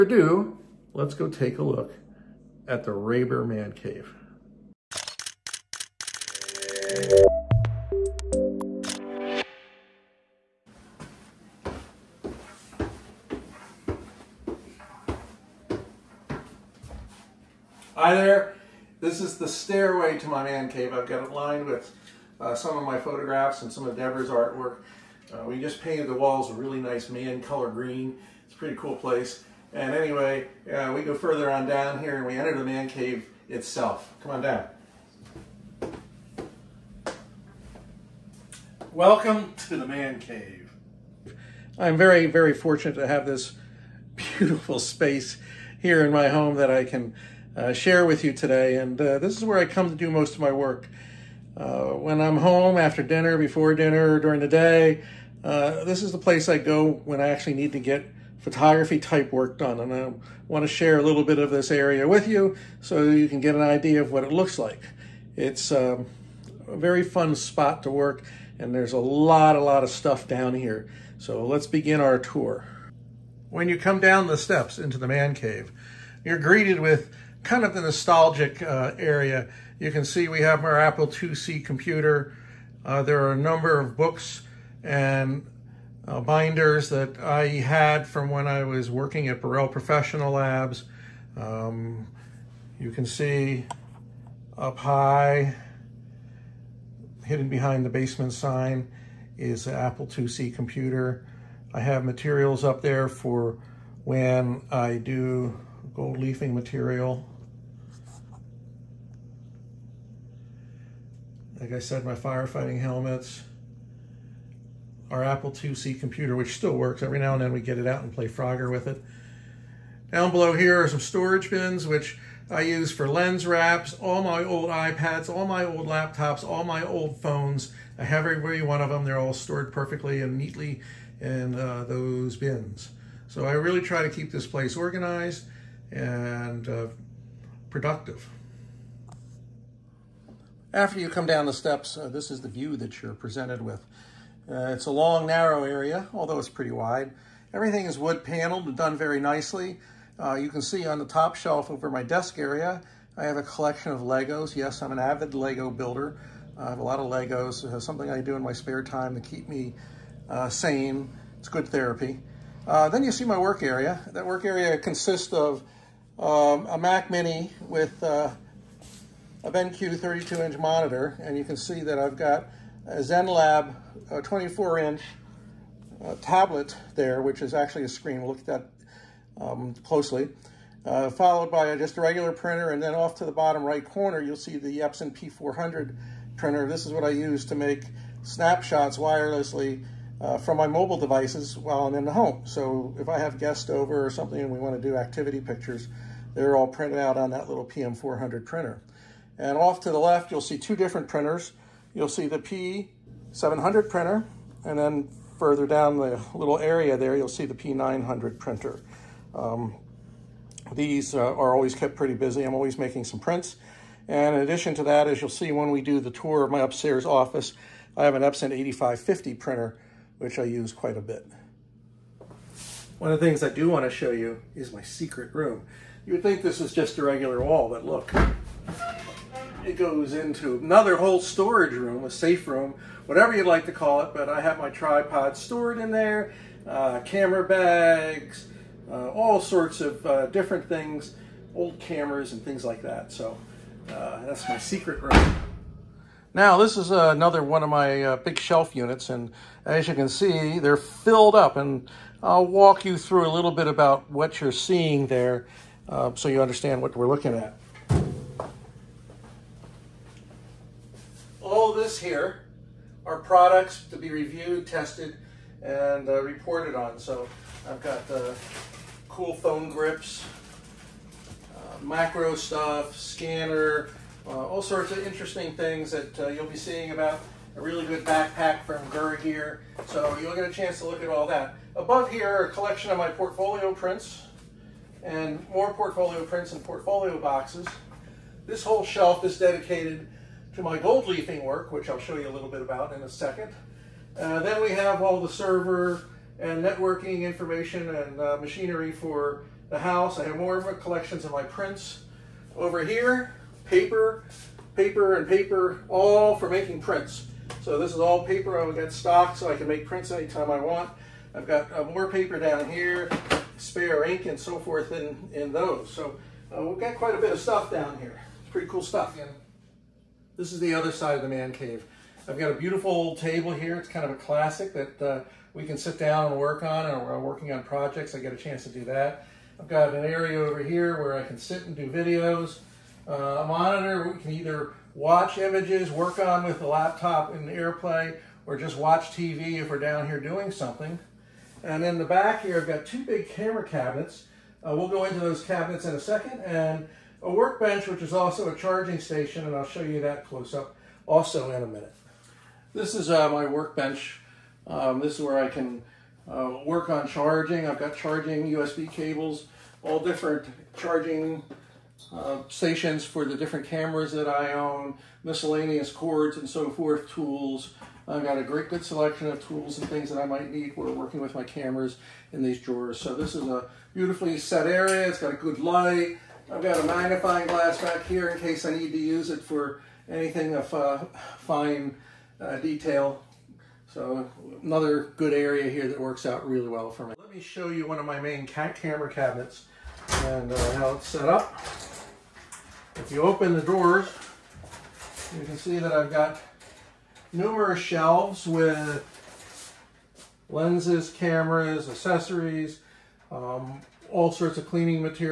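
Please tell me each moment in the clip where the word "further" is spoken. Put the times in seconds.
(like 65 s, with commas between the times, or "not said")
31 s, 205 s.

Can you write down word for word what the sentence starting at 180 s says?
Uh, followed by just a regular printer, and then off to the bottom right corner, you'll see the Epson P400 printer.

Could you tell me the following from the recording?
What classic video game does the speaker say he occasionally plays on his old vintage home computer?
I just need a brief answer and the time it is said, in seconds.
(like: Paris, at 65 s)
Frogger, at 118 s.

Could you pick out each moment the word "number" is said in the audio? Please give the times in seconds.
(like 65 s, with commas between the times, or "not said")
83 s.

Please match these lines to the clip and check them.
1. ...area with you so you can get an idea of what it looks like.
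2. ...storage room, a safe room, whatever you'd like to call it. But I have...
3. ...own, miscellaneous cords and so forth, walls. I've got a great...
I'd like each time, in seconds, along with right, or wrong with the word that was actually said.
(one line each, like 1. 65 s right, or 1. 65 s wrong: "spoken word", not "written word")
1. 61 s right
2. 231 s right
3. 364 s wrong: "tools", not "walls".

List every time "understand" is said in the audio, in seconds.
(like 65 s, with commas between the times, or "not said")
256 s.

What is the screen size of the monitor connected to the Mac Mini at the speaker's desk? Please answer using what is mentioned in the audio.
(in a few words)
32-inch.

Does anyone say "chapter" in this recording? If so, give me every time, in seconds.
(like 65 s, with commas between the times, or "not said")
not said.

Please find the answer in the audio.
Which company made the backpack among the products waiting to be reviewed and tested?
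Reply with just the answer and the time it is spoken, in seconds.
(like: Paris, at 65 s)
Gura Gear, at 278 s.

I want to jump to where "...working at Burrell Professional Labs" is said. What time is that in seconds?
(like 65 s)
88 s.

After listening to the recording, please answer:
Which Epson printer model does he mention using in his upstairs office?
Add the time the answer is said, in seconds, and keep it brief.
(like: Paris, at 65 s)
8550, at 218 s.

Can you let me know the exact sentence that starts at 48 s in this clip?
And uh, this is where I come to do most of my work.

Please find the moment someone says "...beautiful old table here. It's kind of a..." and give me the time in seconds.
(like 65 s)
322 s.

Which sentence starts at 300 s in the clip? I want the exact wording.
I have more of collections of my prints over here, paper, paper and paper, all for making prints.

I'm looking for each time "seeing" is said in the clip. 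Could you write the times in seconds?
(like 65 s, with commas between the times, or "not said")
254 s, 276 s.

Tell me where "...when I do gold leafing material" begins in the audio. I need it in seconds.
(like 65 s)
104 s.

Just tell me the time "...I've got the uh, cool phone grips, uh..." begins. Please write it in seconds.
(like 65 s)
267 s.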